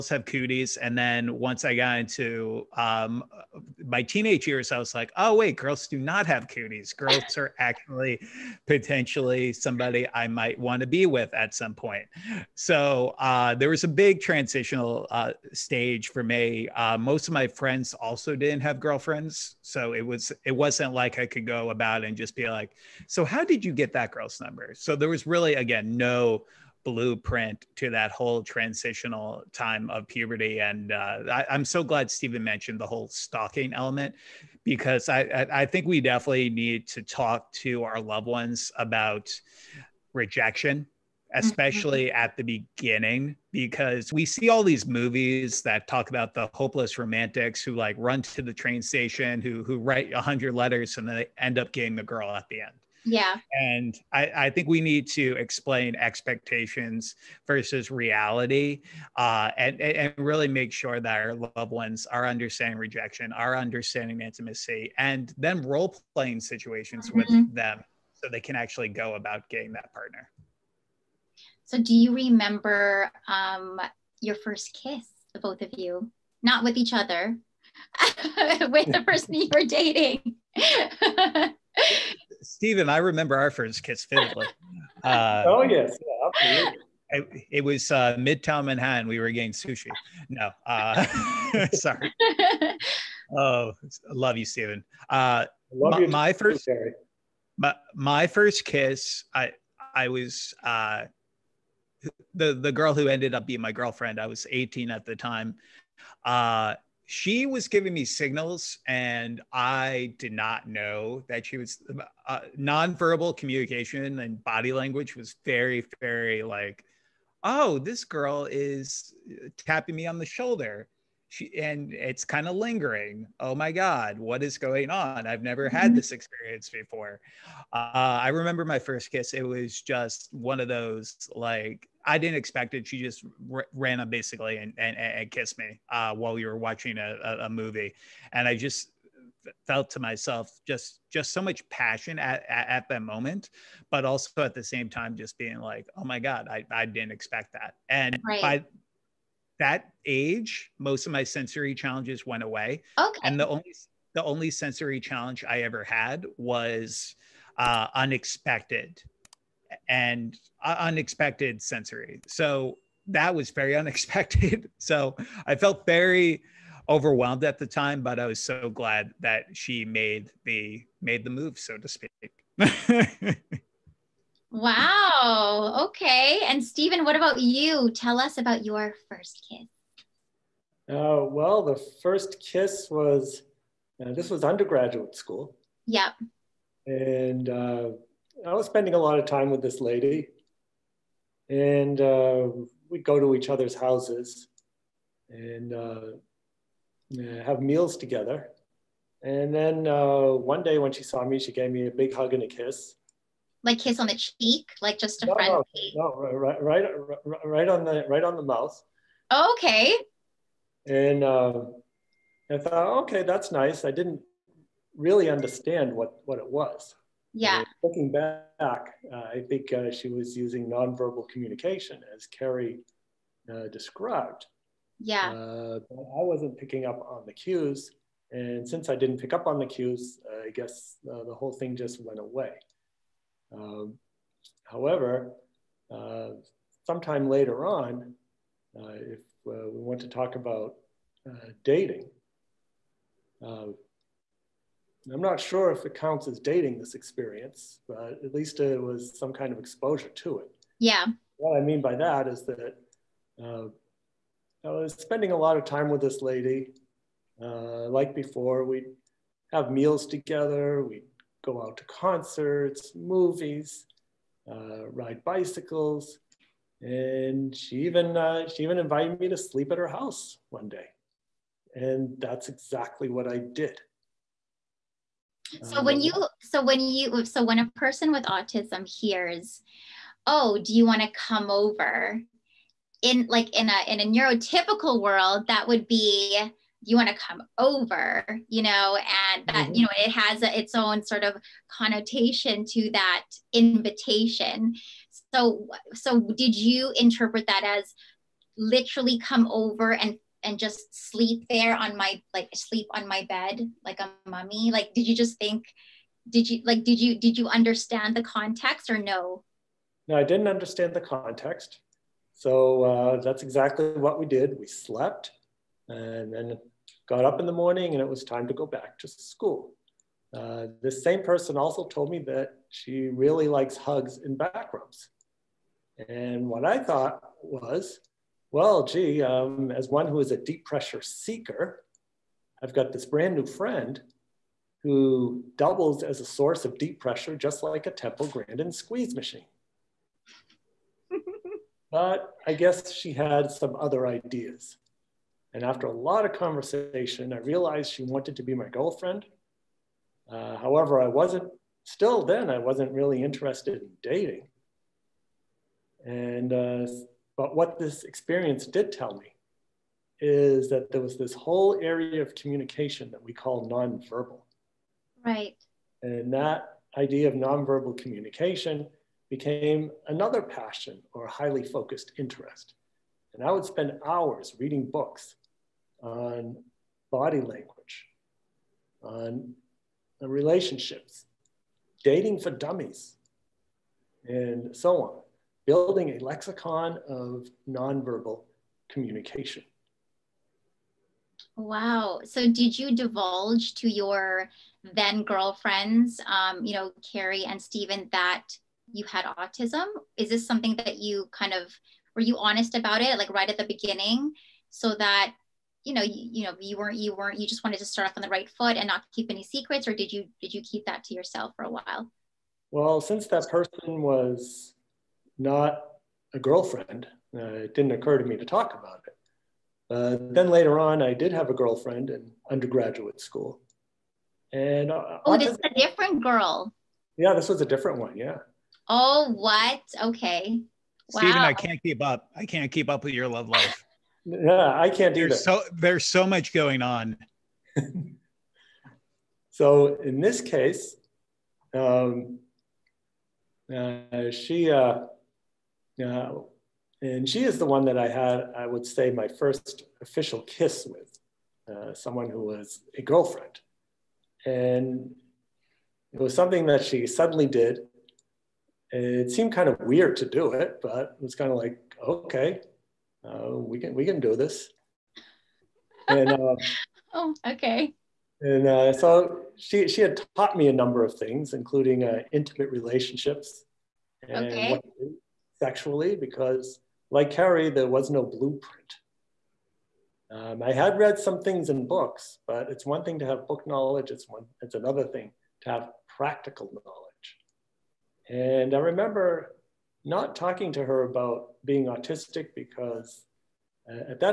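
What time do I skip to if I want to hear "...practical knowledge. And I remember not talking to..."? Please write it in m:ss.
8:06.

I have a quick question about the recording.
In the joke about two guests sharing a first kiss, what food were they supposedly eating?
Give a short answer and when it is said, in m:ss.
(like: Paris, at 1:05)
Sushi, at 1:29.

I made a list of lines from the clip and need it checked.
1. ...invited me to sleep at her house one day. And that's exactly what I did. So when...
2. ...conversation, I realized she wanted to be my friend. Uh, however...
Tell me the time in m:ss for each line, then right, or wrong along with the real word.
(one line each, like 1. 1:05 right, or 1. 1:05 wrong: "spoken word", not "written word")
1. 4:28 right
2. 5:46 wrong: "girlfriend", not "friend".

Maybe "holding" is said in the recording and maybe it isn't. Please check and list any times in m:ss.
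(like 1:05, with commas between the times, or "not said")
not said.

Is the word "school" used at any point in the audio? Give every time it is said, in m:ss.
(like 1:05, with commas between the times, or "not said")
3:05, 5:19, 7:03.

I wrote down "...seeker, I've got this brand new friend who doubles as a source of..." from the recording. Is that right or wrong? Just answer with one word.
right.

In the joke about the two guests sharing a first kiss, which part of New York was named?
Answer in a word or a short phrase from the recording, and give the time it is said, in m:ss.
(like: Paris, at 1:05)
Midtown Manhattan, at 1:28.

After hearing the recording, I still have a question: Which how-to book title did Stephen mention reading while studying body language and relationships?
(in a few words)
Dating for Dummies.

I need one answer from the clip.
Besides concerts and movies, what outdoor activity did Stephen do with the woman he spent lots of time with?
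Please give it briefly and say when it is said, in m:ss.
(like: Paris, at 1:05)
Ride bicycles, at 4:24.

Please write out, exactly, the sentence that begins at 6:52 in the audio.
Well, since that person was not a girlfriend.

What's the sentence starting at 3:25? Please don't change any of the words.
No, no, right, right, right on the right on the mouth.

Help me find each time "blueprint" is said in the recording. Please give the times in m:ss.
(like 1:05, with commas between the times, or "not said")
0:26, 7:58.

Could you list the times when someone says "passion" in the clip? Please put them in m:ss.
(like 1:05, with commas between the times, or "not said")
2:21, 6:10.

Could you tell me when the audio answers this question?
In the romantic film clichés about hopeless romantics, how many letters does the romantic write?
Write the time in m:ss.
0:50.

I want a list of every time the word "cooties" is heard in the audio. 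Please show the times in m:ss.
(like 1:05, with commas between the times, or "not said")
0:00, 0:06.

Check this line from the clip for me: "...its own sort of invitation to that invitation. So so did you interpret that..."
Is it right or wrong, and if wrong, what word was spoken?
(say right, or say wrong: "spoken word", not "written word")
wrong: "connotation", not "invitation".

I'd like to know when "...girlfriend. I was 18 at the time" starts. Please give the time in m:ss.
1:43.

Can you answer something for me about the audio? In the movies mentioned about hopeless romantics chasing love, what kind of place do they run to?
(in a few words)
Train station.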